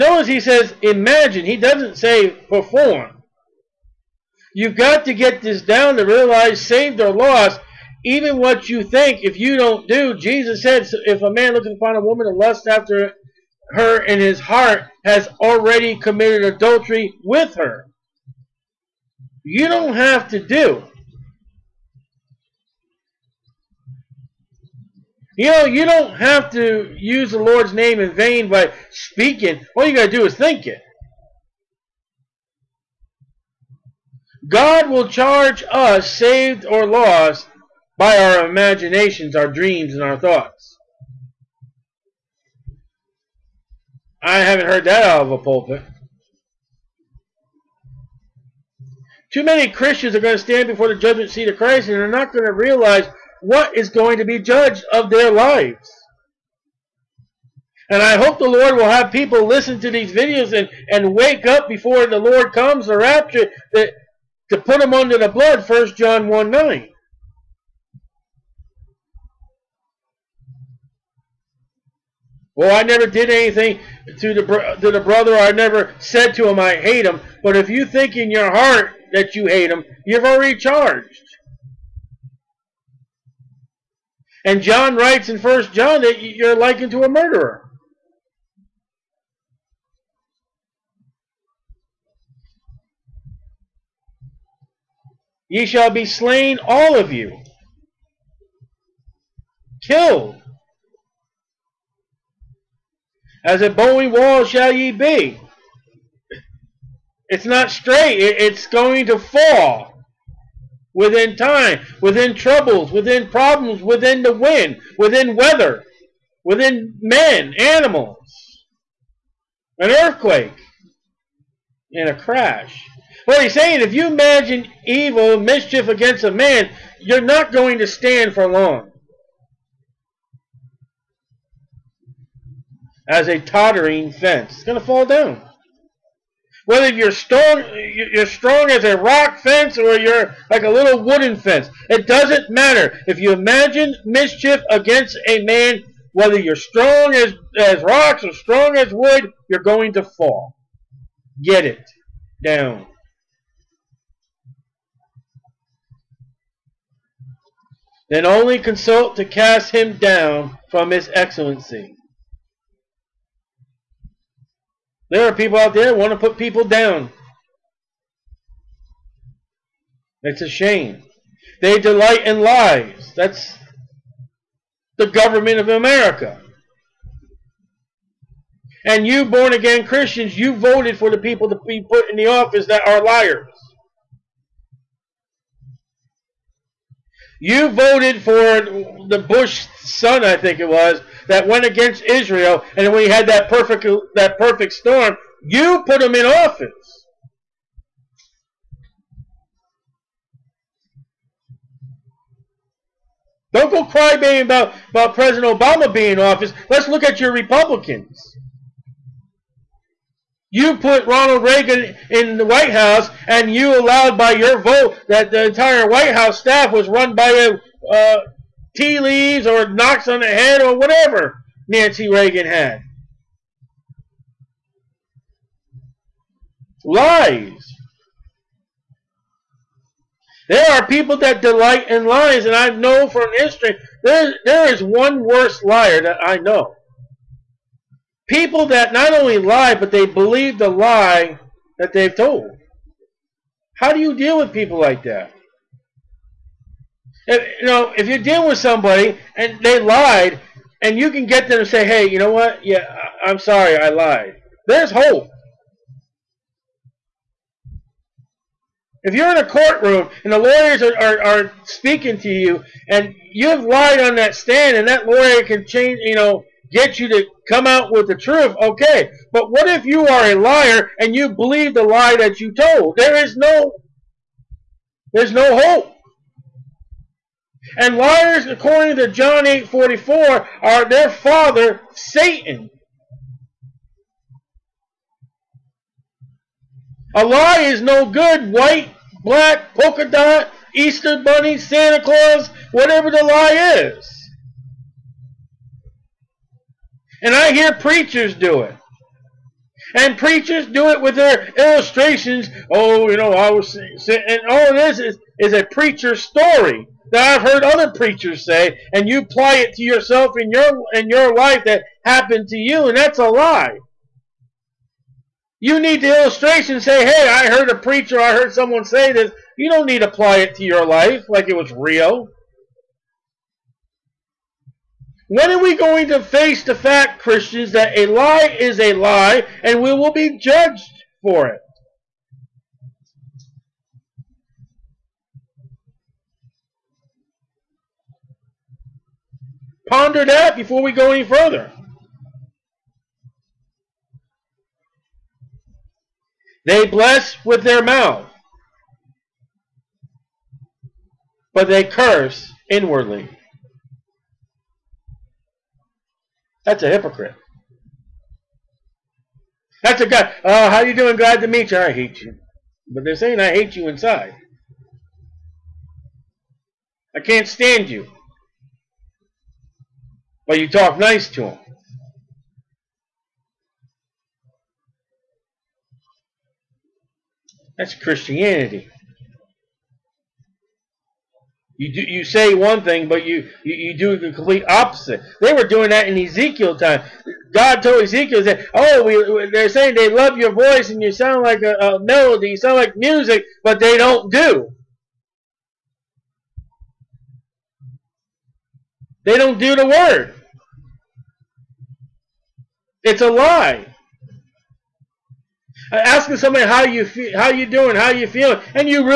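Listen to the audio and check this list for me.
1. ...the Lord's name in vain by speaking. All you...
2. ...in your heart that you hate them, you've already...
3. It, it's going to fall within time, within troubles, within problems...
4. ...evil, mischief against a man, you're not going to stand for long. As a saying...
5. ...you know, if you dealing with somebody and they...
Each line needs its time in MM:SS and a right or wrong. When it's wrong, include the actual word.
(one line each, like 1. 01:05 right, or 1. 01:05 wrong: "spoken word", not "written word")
1. 00:27 right
2. 01:18 right
3. 01:48 right
4. 02:04 wrong: "tottering", not "saying"
5. 04:07 right.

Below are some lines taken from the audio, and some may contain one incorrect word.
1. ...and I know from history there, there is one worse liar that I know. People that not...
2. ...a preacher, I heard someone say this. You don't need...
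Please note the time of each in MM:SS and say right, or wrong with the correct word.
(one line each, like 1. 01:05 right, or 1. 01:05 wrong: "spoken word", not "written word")
1. 03:52 right
2. 05:17 right.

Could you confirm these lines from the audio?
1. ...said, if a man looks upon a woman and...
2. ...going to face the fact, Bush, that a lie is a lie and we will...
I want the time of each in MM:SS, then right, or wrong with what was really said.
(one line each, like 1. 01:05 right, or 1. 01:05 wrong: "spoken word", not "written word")
1. 00:10 right
2. 05:25 wrong: "Christians", not "Bush".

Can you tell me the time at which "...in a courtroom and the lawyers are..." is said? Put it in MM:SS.
04:19.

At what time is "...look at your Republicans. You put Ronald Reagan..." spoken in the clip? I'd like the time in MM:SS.
03:26.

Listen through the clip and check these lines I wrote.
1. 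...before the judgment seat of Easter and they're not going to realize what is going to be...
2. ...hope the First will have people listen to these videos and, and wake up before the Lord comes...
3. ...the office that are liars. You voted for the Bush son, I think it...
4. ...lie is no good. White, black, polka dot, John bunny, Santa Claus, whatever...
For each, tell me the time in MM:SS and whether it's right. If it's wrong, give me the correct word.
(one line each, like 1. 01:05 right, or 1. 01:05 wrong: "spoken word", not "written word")
1. 00:50 wrong: "Christ", not "Easter"
2. 00:58 wrong: "Lord", not "First"
3. 03:02 right
4. 04:47 wrong: "Easter", not "John".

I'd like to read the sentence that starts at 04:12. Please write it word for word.
Yeah, I, I'm sorry, I lied." There's hope.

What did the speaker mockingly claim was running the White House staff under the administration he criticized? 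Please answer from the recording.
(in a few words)
Tea leaves.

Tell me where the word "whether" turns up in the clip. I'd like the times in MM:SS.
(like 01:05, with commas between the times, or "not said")
02:16, 02:26.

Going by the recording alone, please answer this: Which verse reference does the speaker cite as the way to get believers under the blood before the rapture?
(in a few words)
1 John 1:9.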